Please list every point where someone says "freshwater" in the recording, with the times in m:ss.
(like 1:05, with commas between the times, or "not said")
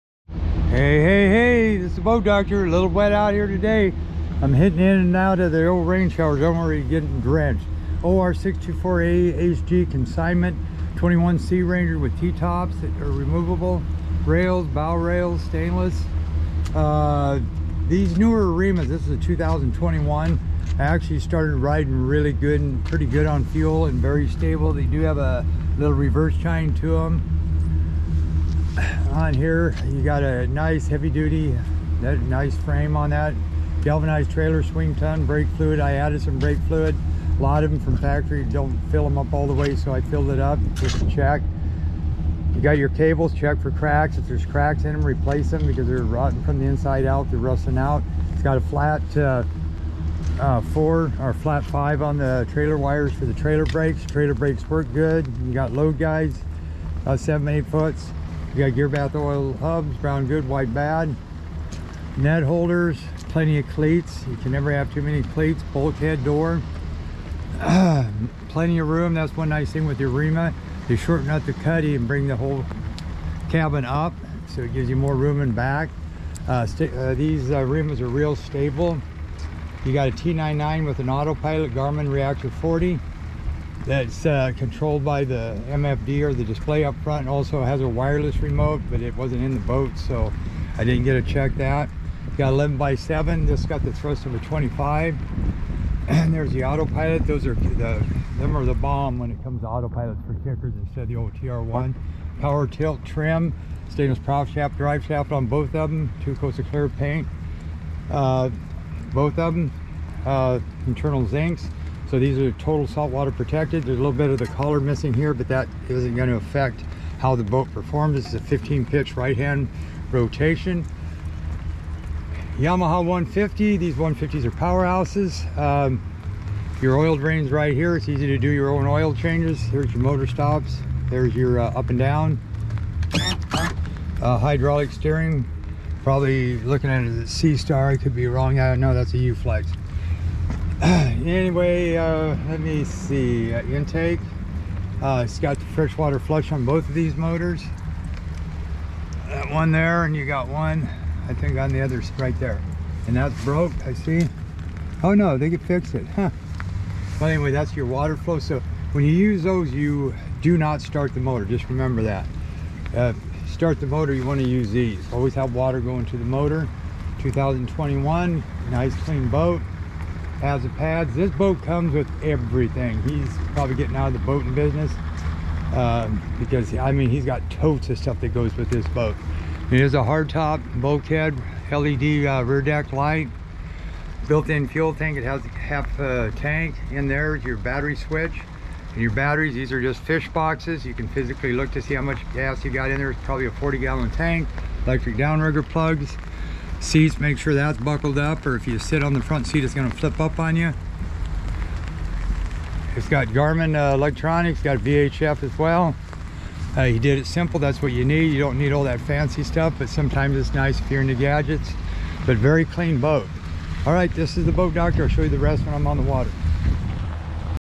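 2:25.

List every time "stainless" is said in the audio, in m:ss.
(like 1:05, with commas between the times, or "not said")
0:15, 1:43.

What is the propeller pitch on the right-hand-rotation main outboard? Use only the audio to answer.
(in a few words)
15.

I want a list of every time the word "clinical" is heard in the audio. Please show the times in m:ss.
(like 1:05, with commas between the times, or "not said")
not said.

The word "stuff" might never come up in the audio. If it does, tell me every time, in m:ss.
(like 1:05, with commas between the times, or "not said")
2:57, 3:29.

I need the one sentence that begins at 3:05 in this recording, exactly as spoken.
It has half a tank in there, your battery switch.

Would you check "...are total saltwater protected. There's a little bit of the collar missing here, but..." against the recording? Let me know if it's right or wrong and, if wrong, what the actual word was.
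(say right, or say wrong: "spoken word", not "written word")
right.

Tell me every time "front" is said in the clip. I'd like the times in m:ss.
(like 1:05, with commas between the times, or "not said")
1:27, 3:19.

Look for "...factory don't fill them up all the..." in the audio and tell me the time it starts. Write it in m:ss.
0:37.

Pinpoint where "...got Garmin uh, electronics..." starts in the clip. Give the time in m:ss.
3:23.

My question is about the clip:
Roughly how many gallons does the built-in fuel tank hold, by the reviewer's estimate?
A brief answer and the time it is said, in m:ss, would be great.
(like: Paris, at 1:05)
40 gallons, at 3:13.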